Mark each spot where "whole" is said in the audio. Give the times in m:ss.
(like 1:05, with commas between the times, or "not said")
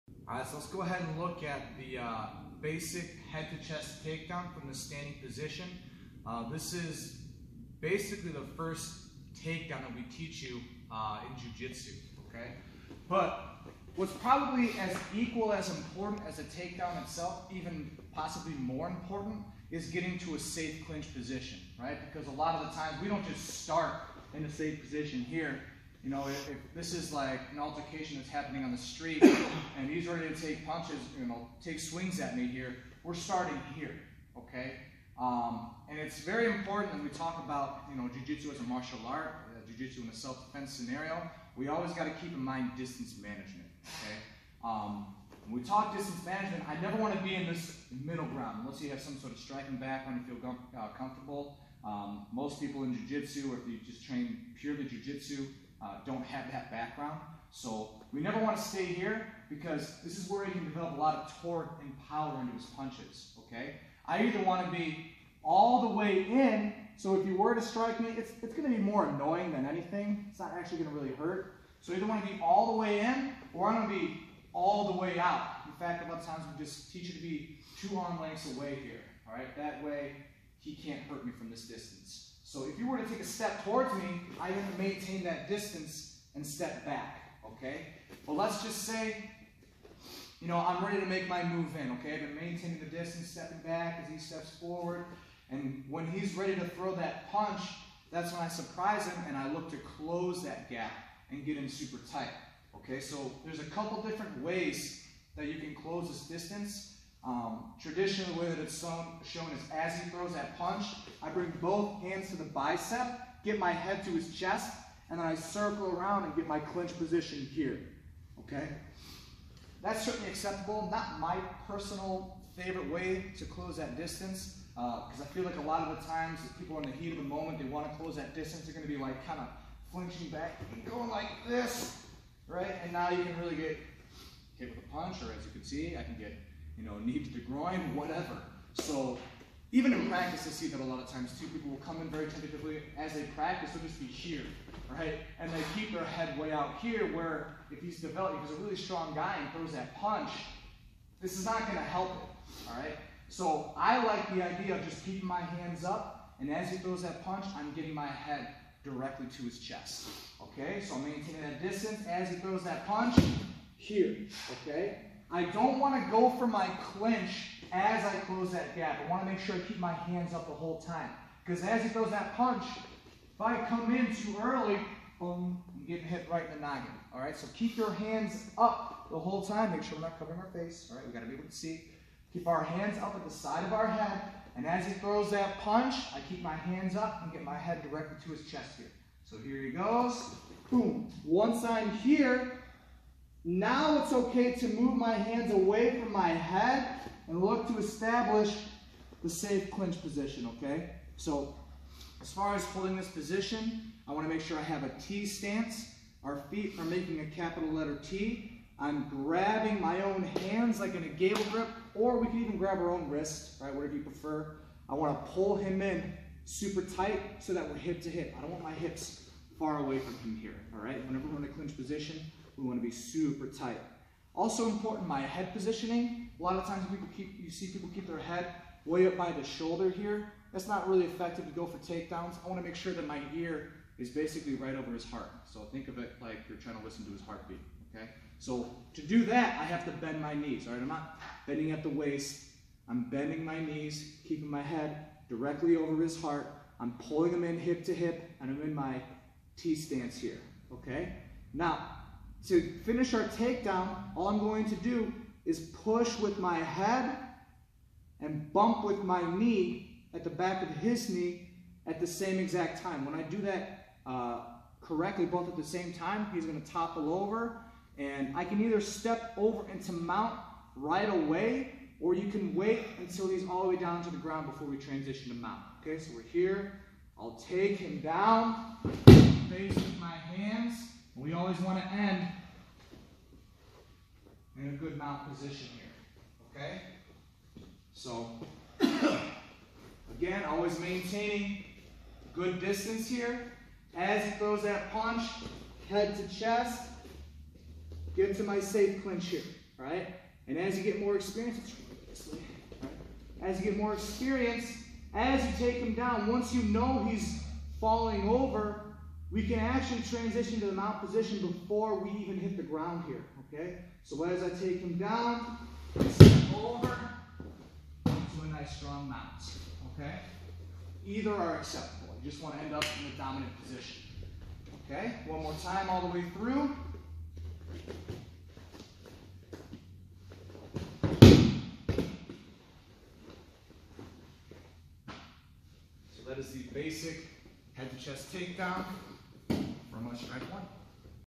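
2:50, 2:59.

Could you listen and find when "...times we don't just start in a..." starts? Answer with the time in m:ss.
0:22.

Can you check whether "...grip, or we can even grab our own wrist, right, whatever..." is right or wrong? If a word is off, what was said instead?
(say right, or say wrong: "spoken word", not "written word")
right.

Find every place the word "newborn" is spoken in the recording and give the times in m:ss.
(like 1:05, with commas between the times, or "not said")
not said.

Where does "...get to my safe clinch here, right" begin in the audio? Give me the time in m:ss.
4:58.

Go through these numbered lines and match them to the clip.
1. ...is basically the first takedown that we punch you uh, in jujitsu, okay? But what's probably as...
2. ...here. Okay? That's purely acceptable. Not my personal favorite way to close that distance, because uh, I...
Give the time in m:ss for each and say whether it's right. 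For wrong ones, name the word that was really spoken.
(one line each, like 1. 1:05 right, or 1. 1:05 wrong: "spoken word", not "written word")
1. 0:06 wrong: "teach", not "punch"
2. 1:57 wrong: "certainly", not "purely".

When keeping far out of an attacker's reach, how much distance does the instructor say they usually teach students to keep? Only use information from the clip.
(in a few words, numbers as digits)
2 arm lengths.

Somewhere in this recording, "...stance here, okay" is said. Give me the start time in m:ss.
4:09.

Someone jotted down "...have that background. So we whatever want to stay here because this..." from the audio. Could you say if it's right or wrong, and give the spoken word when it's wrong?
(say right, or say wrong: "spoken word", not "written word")
wrong: "never", not "whatever".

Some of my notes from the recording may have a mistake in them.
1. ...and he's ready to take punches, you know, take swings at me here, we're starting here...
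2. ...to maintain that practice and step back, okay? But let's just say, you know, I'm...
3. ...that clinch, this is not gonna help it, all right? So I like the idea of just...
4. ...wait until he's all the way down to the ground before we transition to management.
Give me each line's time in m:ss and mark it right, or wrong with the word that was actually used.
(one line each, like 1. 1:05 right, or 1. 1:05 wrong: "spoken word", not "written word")
1. 0:29 right
2. 1:24 wrong: "distance", not "practice"
3. 2:29 wrong: "punch", not "clinch"
4. 4:32 wrong: "mount", not "management".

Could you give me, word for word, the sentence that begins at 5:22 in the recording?
You just want to end up in the dominant position.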